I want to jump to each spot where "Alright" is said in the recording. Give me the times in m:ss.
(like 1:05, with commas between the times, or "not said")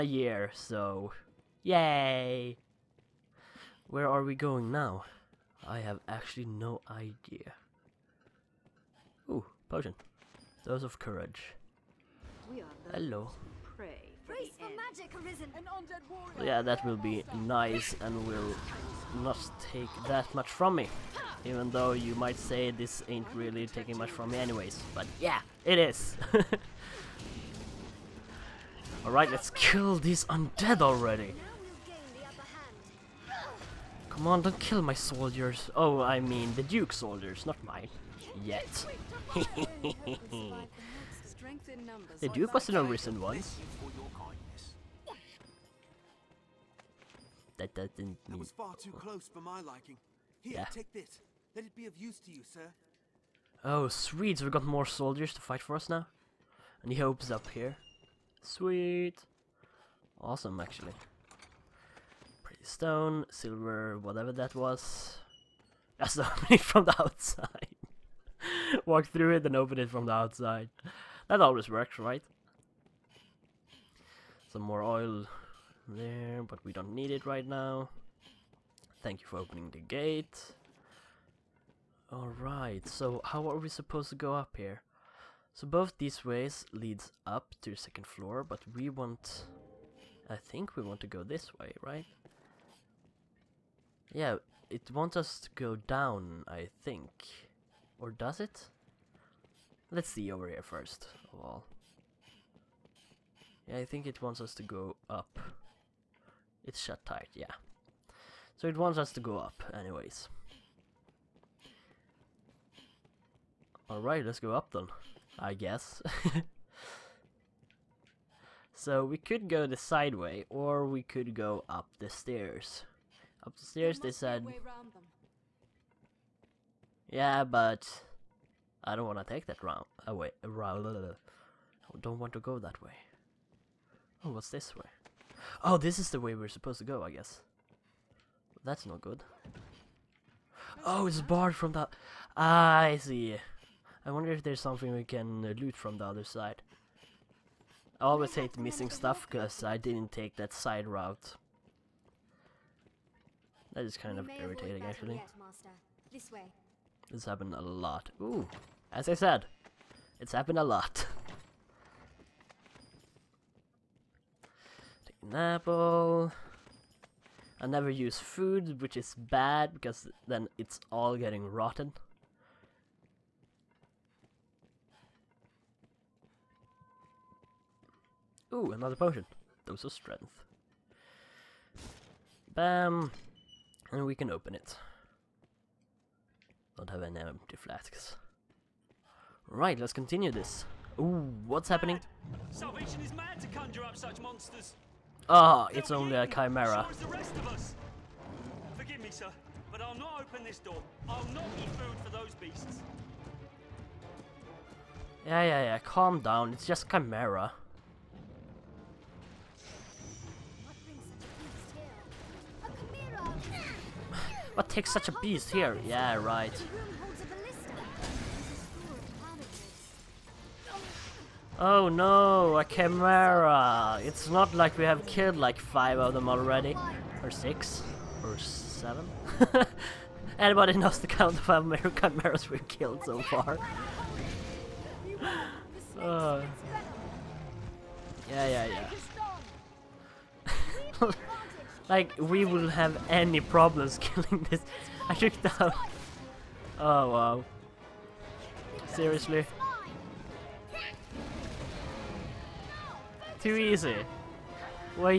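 0:29, 1:22, 1:53.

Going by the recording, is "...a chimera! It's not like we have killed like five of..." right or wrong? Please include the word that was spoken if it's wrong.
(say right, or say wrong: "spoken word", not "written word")
right.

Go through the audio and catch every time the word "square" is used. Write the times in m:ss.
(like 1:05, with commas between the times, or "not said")
not said.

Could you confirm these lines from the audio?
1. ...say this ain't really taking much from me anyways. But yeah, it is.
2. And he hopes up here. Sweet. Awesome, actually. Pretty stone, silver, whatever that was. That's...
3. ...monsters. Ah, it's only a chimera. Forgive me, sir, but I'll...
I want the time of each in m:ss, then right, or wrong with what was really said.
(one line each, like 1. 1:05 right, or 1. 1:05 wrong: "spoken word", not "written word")
1. 0:22 right
2. 0:56 right
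3. 3:14 right.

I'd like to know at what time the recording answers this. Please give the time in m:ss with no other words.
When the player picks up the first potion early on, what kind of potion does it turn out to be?
0:10.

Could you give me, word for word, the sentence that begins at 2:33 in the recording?
That is kind of irritating actually.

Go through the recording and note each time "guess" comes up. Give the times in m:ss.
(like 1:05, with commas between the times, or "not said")
1:55, 2:17.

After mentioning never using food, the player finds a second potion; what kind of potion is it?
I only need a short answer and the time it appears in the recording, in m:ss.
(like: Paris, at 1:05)
Strength, at 2:59.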